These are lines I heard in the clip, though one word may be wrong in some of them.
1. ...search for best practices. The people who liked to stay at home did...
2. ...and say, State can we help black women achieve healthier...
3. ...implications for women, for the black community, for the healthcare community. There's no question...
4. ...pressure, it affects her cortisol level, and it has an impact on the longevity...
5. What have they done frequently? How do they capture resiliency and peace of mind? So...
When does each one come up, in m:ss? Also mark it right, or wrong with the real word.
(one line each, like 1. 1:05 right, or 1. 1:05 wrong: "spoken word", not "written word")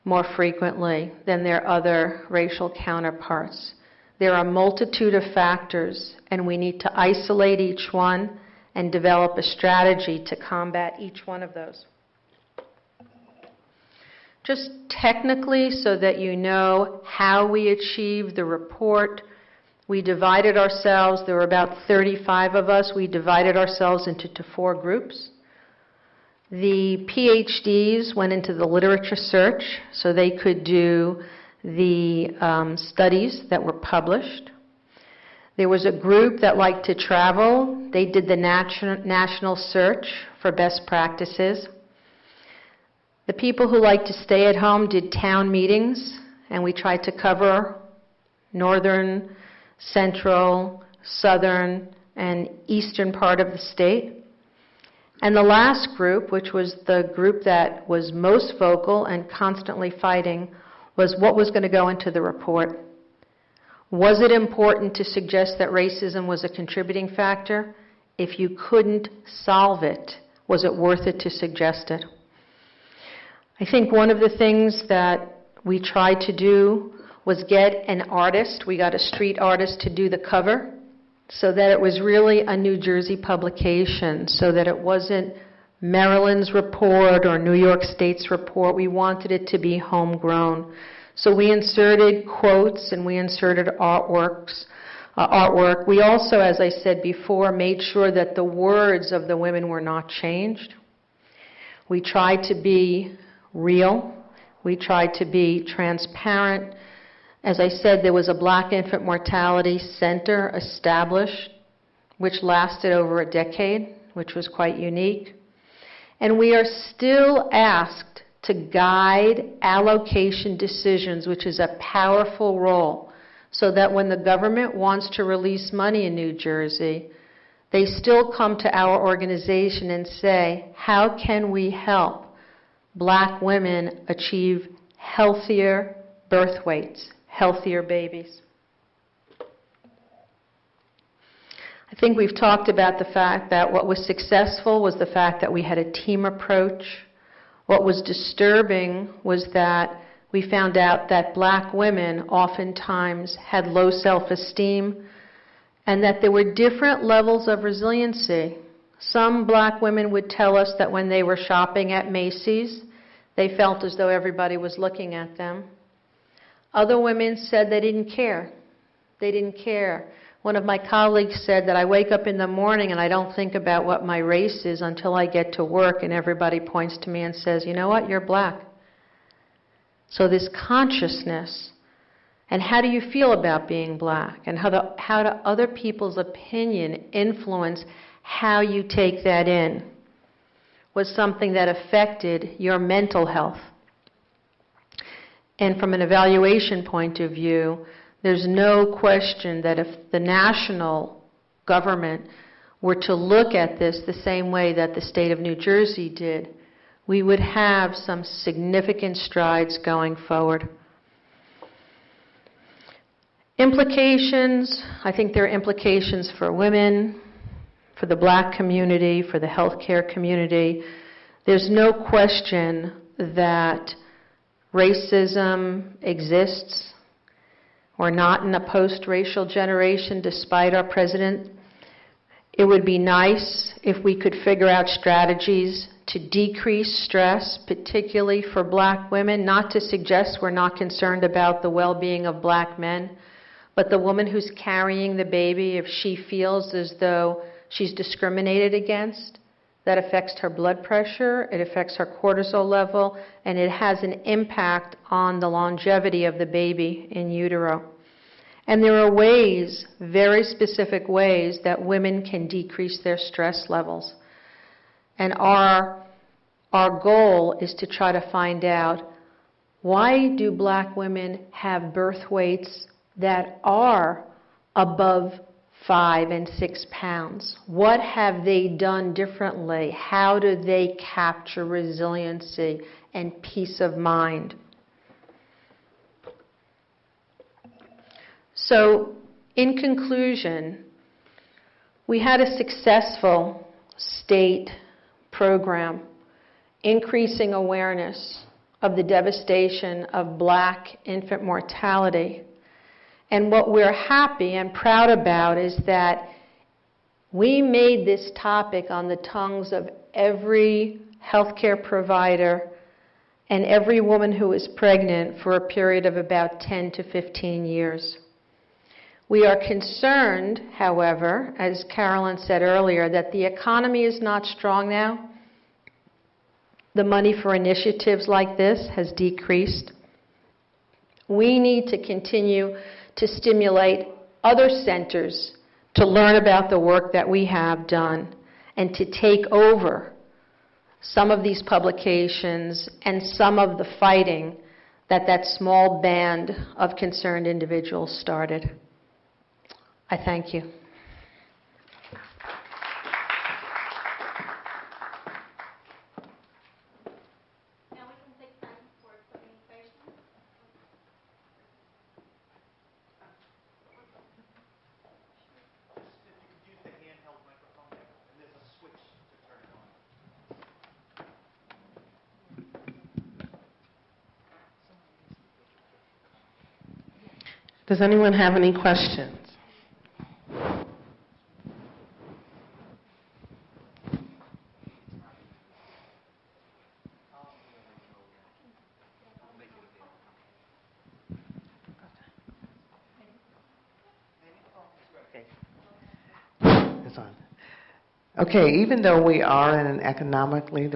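1. 0:39 right
2. 2:09 wrong: "How", not "State"
3. 3:35 right
4. 4:10 right
5. 4:37 wrong: "differently", not "frequently".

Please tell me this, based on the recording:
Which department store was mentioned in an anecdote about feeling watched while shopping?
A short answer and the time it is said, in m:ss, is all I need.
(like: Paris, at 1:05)
Macy's, at 2:42.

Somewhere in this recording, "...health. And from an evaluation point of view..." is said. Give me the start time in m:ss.
3:13.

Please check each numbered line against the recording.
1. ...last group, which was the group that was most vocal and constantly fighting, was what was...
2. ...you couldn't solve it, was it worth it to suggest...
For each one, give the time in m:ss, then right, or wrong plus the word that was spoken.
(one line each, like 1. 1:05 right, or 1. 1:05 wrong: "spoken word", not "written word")
1. 0:55 right
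2. 1:08 right.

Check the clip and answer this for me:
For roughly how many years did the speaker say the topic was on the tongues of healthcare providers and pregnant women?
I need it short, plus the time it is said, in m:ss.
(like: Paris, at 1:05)
10 to 15 years, at 5:16.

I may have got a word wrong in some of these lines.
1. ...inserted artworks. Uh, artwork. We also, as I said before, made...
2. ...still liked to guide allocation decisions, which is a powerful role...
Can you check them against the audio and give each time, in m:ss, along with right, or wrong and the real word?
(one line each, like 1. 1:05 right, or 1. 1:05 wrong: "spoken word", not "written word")
1. 1:33 right
2. 1:56 wrong: "asked", not "liked".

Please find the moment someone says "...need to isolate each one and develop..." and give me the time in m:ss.
0:06.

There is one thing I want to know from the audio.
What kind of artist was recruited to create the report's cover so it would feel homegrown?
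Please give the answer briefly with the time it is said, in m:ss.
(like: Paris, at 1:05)
Street artist, at 1:18.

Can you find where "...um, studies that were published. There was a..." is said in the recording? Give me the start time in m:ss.
0:32.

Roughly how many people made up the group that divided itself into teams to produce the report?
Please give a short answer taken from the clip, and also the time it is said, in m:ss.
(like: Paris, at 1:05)
35, at 0:21.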